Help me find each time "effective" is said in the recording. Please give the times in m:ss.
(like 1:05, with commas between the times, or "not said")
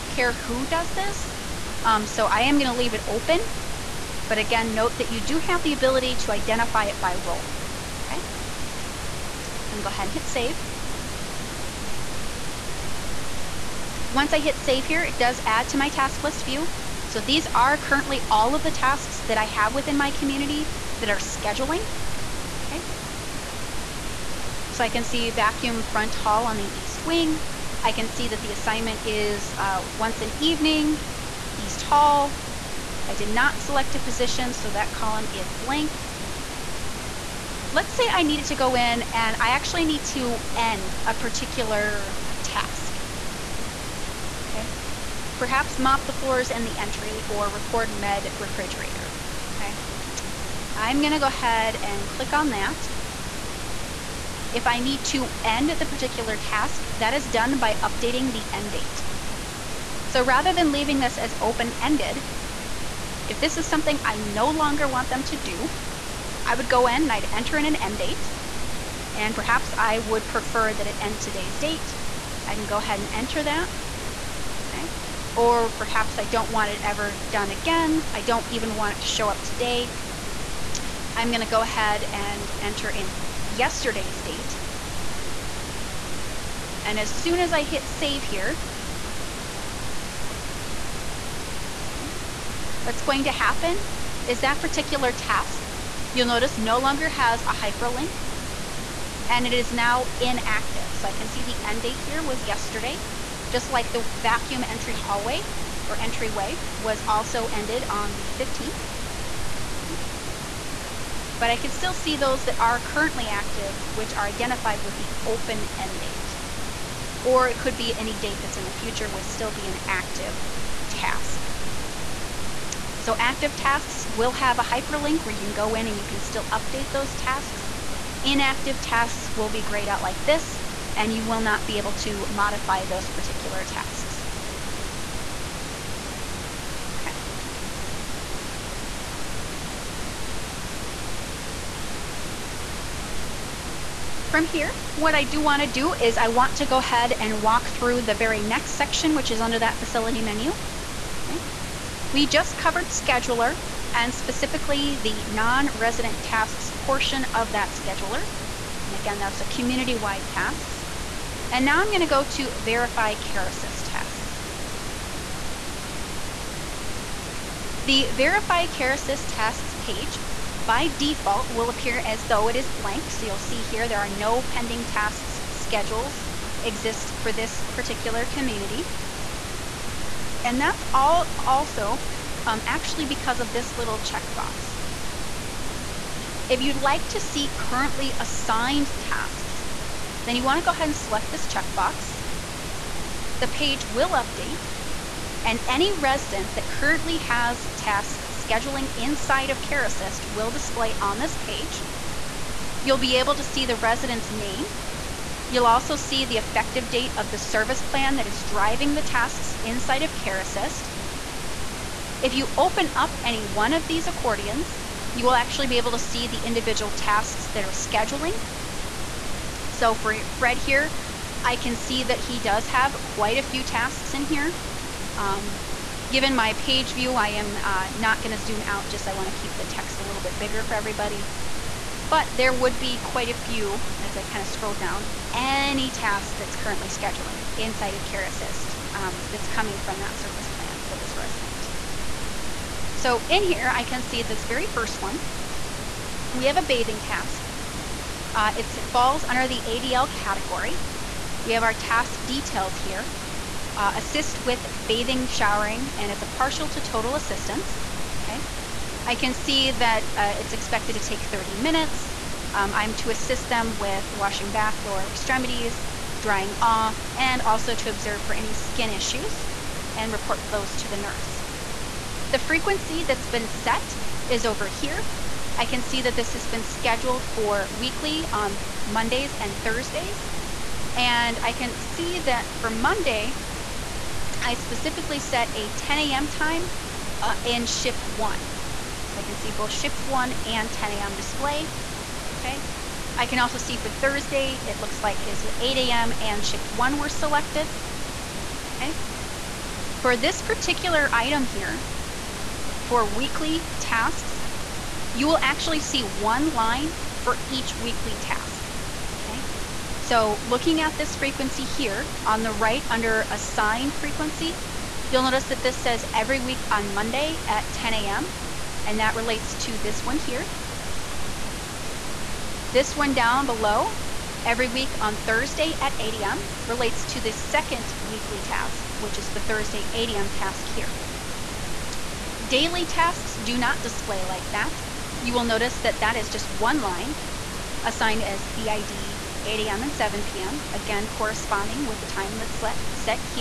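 3:26.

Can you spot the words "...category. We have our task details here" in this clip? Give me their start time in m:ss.
4:10.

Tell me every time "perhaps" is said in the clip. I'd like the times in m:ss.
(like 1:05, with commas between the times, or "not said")
0:45, 1:09, 1:15.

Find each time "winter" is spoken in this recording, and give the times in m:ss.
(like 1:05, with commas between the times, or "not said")
not said.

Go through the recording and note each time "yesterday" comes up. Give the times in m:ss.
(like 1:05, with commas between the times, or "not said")
1:23, 1:42.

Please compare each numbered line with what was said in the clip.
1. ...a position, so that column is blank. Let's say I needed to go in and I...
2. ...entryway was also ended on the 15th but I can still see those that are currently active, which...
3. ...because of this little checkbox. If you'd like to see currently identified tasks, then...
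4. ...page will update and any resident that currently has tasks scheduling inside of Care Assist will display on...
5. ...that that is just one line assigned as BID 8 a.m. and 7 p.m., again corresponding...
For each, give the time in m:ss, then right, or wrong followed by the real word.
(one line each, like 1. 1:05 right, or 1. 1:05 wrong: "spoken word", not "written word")
1. 0:33 right
2. 1:46 right
3. 3:03 wrong: "assigned", not "identified"
4. 3:13 right
5. 5:35 right.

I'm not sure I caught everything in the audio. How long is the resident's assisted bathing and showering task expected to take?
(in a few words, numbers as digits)
30 minutes.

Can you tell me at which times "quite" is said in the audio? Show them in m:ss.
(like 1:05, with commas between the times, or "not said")
3:43, 3:53.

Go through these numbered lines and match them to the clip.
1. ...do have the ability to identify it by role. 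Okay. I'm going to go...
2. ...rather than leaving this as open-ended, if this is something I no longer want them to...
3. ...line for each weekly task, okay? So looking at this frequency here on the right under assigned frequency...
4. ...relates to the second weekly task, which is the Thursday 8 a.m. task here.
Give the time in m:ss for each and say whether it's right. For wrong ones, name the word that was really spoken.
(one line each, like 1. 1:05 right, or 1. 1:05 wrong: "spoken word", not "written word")
1. 0:05 right
2. 1:00 right
3. 5:06 right
4. 5:26 right.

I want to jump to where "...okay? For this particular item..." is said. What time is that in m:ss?
4:58.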